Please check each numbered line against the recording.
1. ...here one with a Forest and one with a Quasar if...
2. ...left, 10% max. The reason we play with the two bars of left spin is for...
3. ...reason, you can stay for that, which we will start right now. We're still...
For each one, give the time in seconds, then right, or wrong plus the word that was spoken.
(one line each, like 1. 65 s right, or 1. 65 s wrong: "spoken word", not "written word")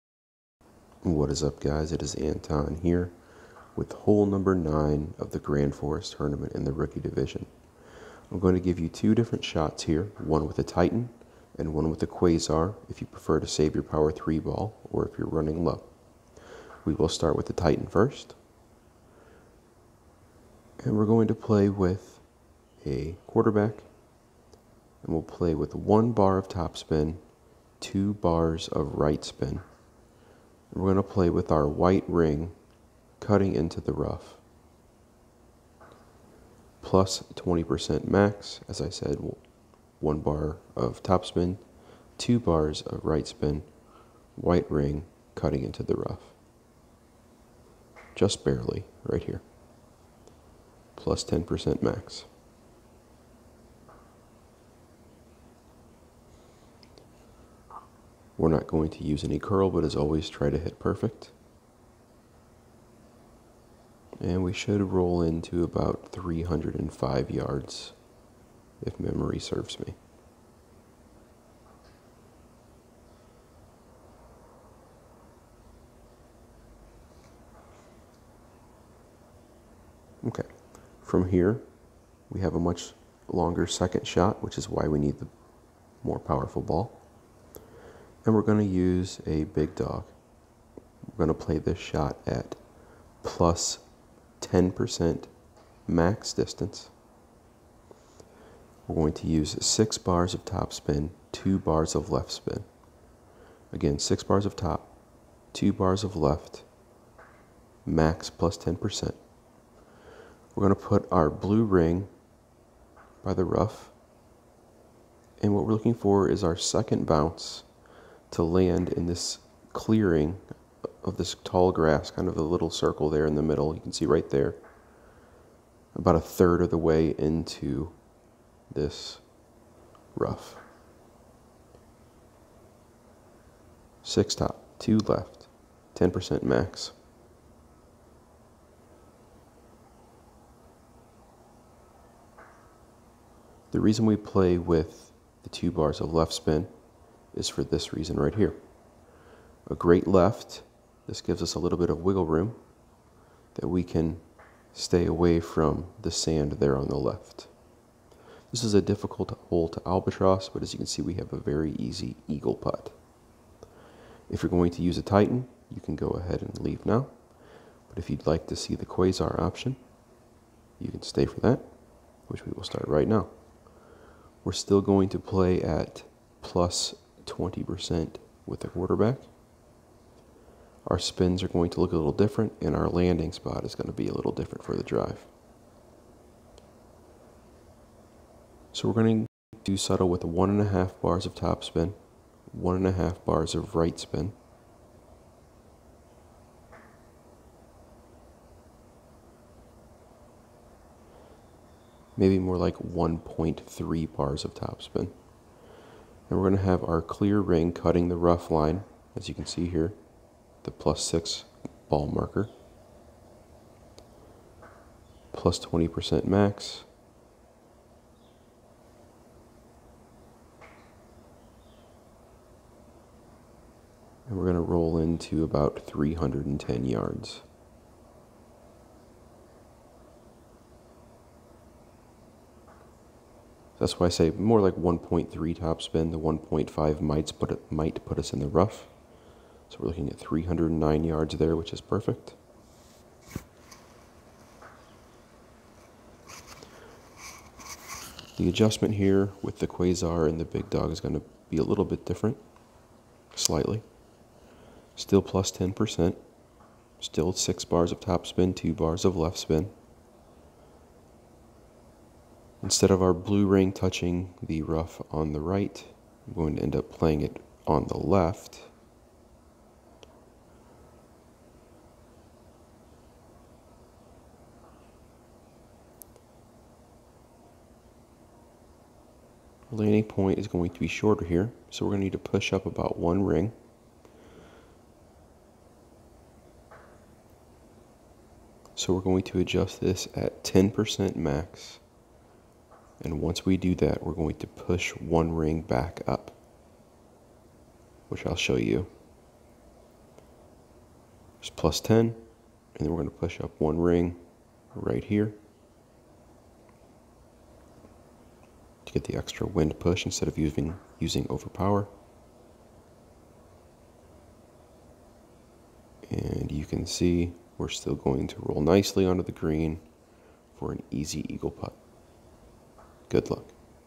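1. 9 s wrong: "Titan", not "Forest"
2. 134 s right
3. 169 s wrong: "option", not "reason".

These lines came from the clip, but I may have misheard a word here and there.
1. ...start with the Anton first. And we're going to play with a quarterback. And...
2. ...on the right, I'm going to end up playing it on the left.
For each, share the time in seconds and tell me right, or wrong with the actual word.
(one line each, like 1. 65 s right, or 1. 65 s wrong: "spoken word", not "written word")
1. 17 s wrong: "Titan", not "Anton"
2. 265 s right.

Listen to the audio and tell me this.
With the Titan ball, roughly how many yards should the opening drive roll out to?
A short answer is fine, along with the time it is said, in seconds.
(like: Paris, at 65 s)
305 yards, at 65 s.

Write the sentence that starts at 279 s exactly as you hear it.
landing point is going to be shorter here, so we're going to need to push up about one ring.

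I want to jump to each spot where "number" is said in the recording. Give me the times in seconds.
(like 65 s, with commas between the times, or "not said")
4 s.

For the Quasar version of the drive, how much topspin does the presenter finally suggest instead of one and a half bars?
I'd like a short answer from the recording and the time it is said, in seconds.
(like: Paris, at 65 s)
1.3 bars, at 202 s.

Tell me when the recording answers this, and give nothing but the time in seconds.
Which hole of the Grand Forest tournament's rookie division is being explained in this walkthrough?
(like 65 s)
3 s.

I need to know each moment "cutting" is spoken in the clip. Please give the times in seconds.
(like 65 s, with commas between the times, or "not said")
33 s, 45 s, 207 s.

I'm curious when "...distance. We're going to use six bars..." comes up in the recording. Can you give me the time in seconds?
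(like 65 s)
96 s.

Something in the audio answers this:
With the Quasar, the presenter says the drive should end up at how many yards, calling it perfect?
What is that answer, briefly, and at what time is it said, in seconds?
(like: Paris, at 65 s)
309 yards, at 240 s.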